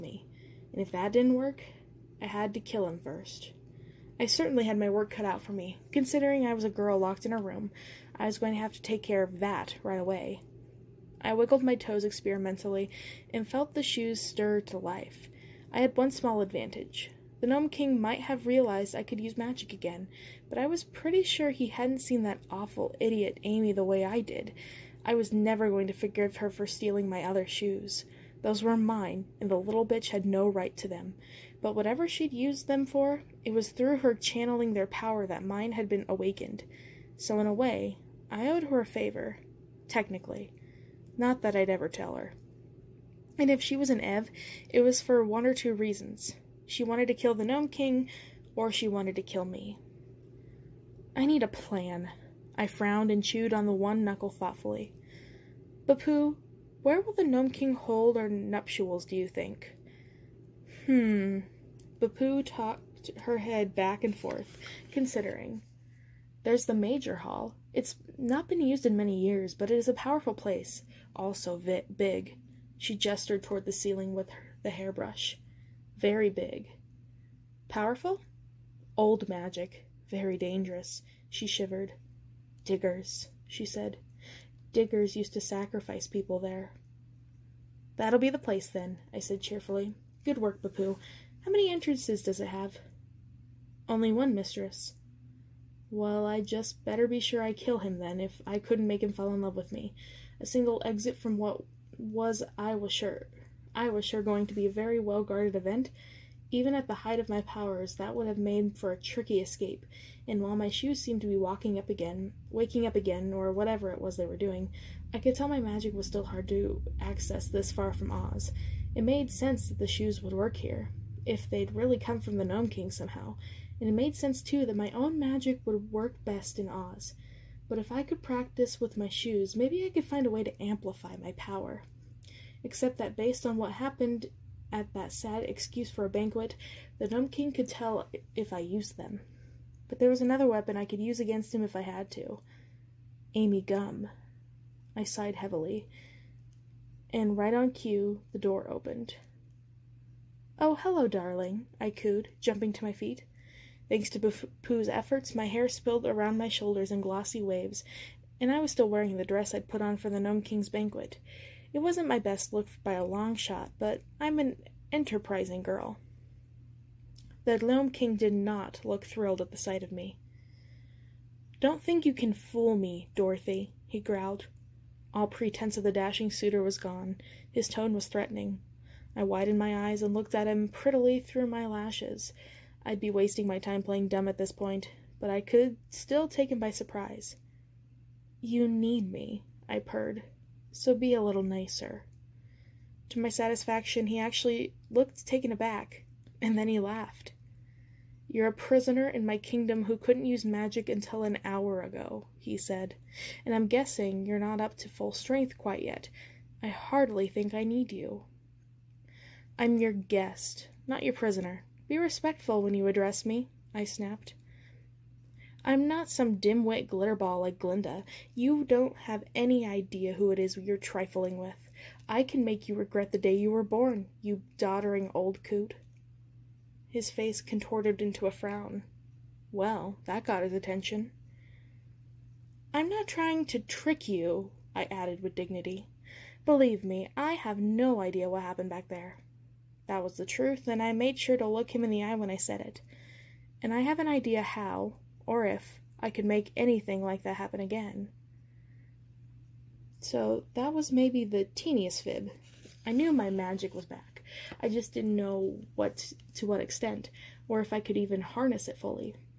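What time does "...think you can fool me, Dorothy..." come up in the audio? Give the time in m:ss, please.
2:51.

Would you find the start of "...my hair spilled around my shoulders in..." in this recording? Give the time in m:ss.
2:35.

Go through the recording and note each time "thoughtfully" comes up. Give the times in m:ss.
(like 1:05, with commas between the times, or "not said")
0:54.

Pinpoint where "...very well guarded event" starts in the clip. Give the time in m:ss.
1:44.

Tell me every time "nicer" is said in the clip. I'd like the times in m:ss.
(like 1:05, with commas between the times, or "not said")
3:11.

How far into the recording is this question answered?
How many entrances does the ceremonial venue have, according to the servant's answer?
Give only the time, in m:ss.
1:33.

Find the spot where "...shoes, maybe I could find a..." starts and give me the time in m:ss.
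2:09.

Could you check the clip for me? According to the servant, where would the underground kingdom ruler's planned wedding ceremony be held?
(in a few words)
The Major Hall.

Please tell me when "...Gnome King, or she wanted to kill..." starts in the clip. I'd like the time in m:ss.
0:47.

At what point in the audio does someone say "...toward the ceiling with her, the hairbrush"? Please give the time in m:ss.
1:13.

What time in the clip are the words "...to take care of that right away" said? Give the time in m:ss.
0:08.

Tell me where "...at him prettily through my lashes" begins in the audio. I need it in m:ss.
3:00.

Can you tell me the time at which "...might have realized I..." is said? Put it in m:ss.
0:18.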